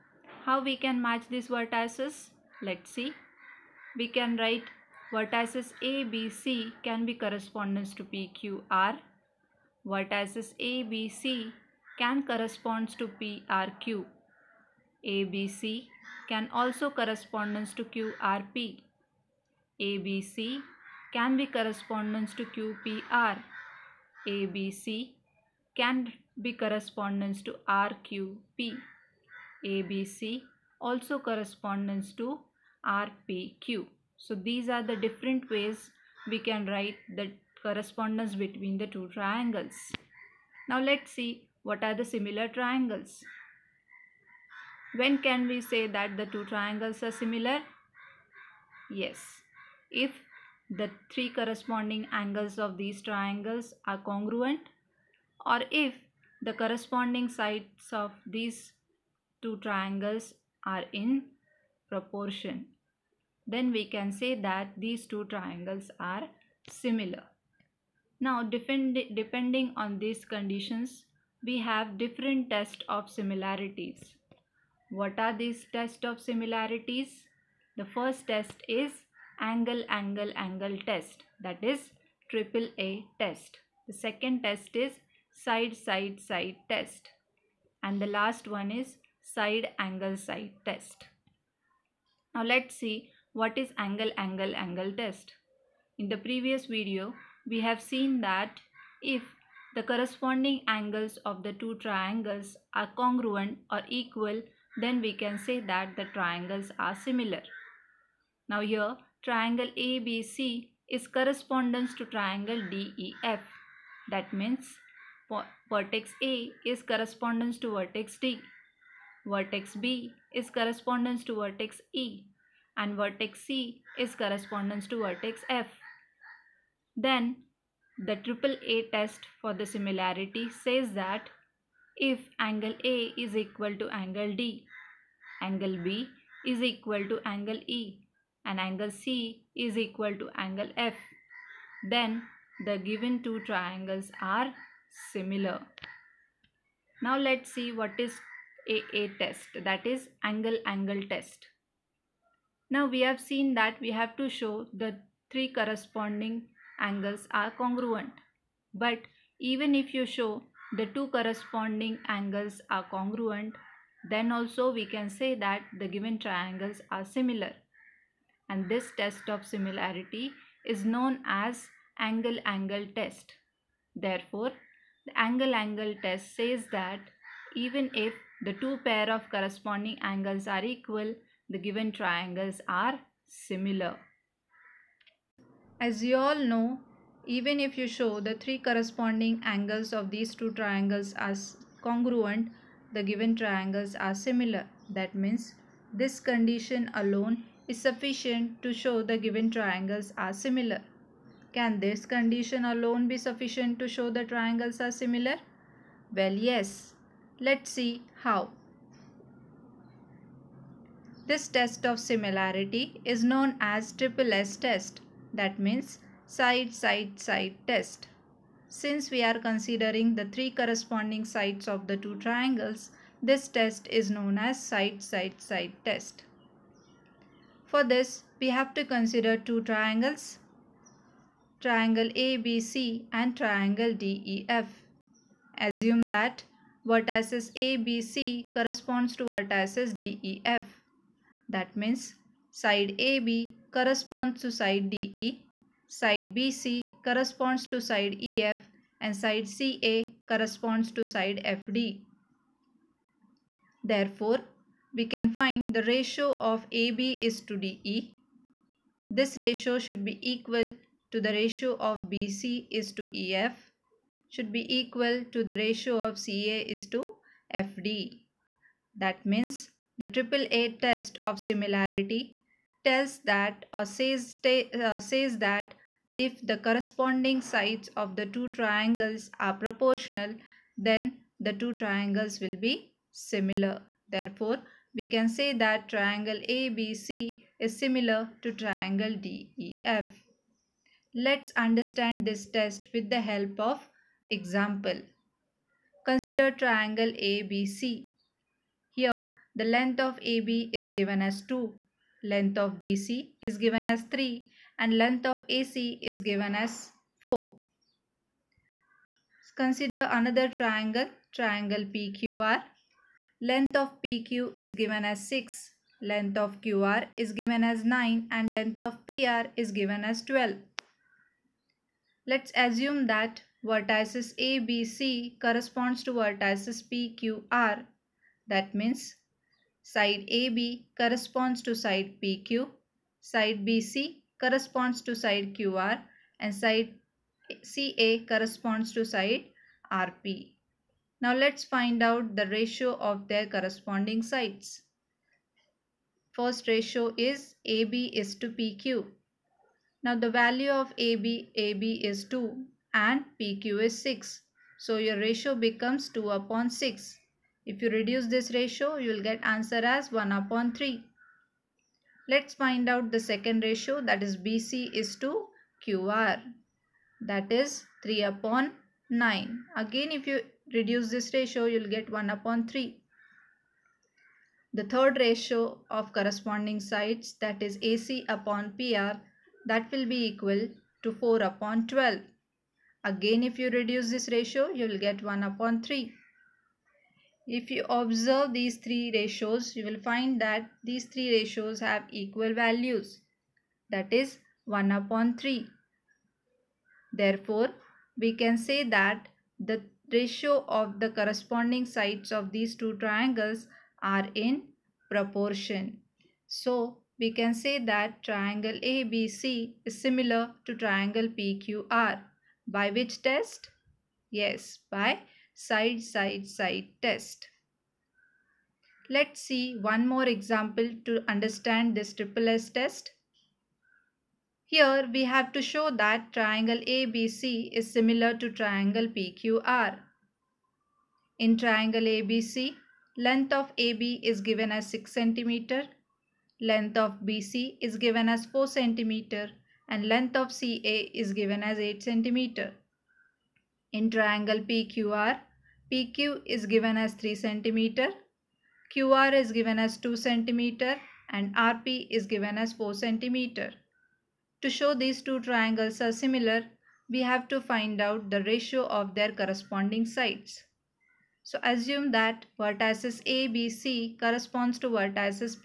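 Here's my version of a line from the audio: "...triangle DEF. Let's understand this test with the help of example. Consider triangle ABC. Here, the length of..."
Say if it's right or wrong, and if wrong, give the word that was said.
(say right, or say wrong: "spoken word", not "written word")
right.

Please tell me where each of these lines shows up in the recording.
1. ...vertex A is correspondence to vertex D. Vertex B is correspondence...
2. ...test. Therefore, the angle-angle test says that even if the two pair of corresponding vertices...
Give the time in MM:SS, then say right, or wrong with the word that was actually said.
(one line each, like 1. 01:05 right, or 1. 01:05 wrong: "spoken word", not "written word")
1. 01:55 right
2. 02:52 wrong: "angles", not "vertices".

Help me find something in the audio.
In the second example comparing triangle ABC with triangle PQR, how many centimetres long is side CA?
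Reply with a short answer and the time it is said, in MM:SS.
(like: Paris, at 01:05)
8 cm, at 07:21.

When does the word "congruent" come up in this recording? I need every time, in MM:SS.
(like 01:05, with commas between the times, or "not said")
00:53, 01:42, 02:37, 02:42, 03:11.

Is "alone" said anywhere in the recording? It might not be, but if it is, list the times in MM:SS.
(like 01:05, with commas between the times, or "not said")
03:16, 03:22.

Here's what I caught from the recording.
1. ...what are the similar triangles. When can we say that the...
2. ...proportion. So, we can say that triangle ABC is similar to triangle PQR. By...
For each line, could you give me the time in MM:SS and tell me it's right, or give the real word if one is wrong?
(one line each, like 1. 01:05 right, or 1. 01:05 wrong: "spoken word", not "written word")
1. 00:41 right
2. 06:45 right.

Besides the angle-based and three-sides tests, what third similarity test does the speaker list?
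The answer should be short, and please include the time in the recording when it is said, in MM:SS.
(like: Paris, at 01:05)
side angle side test, at 01:29.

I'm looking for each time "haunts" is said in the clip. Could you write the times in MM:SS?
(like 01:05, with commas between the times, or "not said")
not said.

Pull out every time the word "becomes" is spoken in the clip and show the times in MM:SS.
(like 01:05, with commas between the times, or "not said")
05:55.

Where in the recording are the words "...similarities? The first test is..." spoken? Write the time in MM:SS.
01:16.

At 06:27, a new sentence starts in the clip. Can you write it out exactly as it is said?
If you observe these three ratios, you will find that these three ratios have equal values.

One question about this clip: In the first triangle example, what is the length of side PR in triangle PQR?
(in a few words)
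12.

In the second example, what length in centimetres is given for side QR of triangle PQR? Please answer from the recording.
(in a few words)
2 cm.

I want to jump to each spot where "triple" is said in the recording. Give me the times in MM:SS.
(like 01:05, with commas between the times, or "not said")
01:22, 02:08, 03:33, 07:02.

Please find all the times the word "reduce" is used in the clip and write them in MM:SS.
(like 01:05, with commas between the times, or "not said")
05:57, 06:10, 06:23.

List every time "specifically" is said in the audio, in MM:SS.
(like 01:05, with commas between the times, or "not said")
not said.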